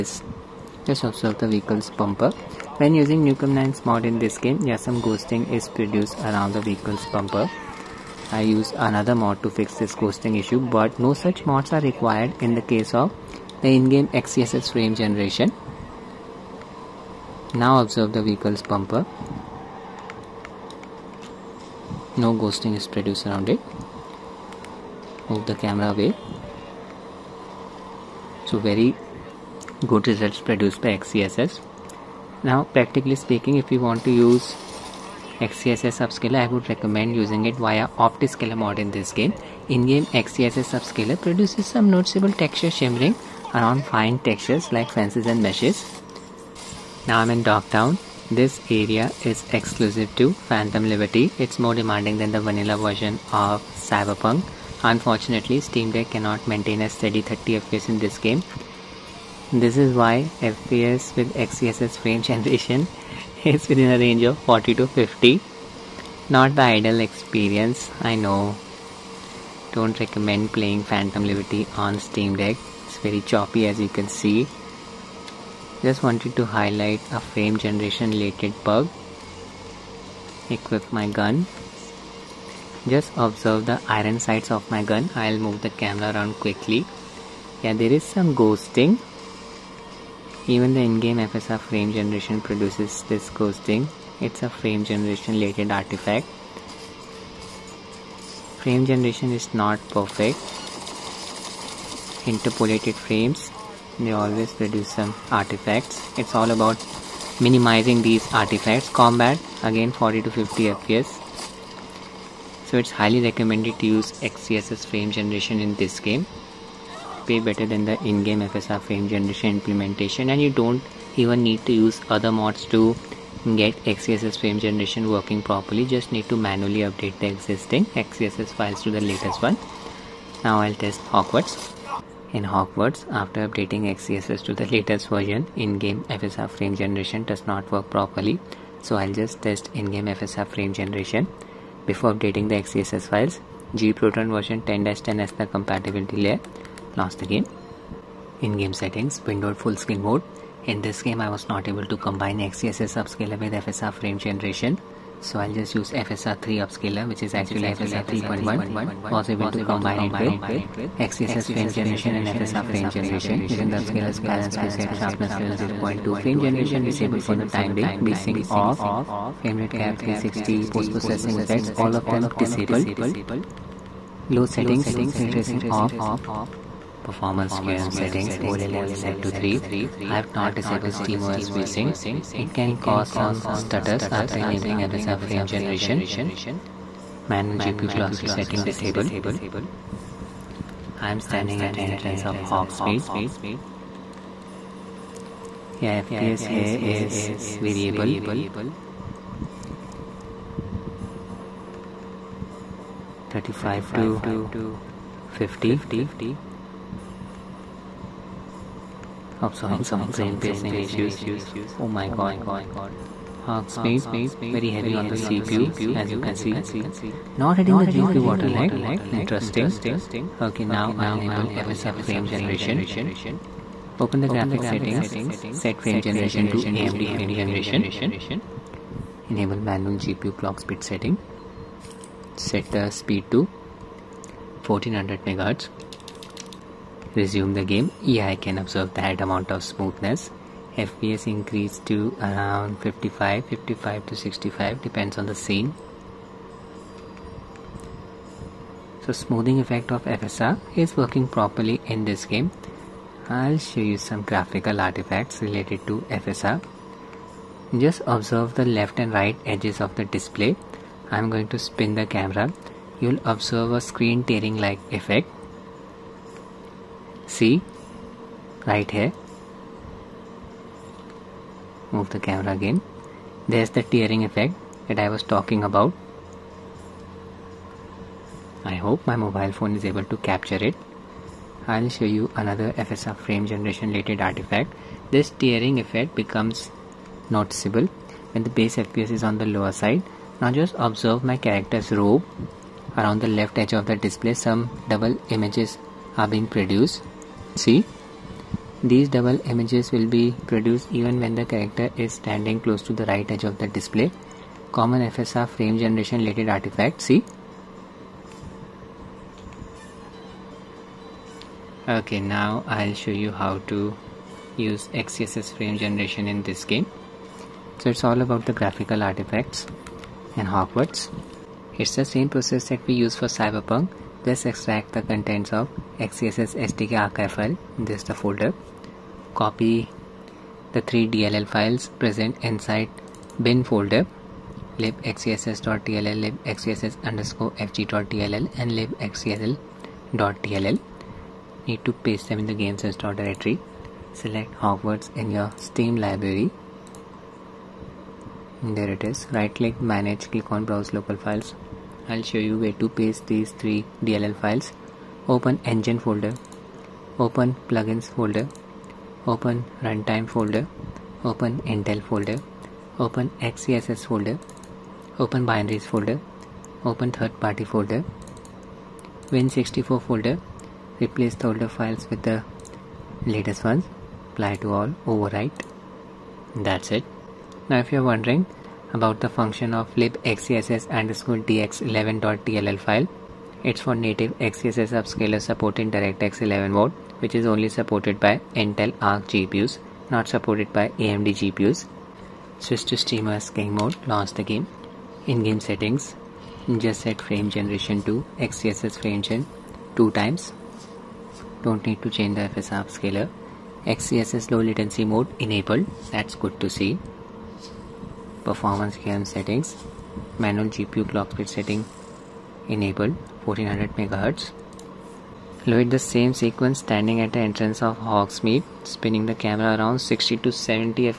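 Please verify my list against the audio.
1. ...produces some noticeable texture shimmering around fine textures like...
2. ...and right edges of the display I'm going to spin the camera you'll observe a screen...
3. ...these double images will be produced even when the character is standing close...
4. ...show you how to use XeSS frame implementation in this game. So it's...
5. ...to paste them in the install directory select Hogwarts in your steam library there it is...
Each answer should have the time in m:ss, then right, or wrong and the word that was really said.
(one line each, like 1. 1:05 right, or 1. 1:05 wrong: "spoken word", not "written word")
1. 0:41 right
2. 4:18 right
3. 4:58 right
4. 5:12 wrong: "generation", not "implementation"
5. 5:41 right.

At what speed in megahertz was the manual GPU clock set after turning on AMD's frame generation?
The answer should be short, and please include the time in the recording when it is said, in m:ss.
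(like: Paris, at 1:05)
1400 MHz, at 3:54.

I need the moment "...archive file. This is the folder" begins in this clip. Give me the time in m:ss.
5:26.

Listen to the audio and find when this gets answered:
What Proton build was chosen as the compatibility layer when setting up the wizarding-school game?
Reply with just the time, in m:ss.
2:23.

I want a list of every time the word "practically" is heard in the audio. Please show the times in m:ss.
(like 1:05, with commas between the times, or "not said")
0:32.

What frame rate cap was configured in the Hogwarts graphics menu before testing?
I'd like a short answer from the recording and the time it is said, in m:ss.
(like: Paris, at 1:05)
360, at 2:49.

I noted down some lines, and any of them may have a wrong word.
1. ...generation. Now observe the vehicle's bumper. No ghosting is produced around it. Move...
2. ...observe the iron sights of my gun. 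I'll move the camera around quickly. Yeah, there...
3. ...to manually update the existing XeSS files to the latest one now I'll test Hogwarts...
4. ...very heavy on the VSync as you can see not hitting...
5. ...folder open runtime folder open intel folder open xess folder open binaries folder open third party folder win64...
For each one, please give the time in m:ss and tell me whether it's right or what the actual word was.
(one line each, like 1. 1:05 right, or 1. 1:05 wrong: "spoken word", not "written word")
1. 0:14 right
2. 1:23 right
3. 2:06 right
4. 3:34 wrong: "CPU", not "VSync"
5. 5:58 right.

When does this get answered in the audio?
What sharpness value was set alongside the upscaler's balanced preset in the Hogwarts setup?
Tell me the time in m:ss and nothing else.
2:45.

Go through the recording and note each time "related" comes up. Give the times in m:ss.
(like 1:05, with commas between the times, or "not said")
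1:18, 1:35, 4:15, 4:43, 5:06.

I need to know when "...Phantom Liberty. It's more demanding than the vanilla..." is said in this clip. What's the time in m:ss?
0:50.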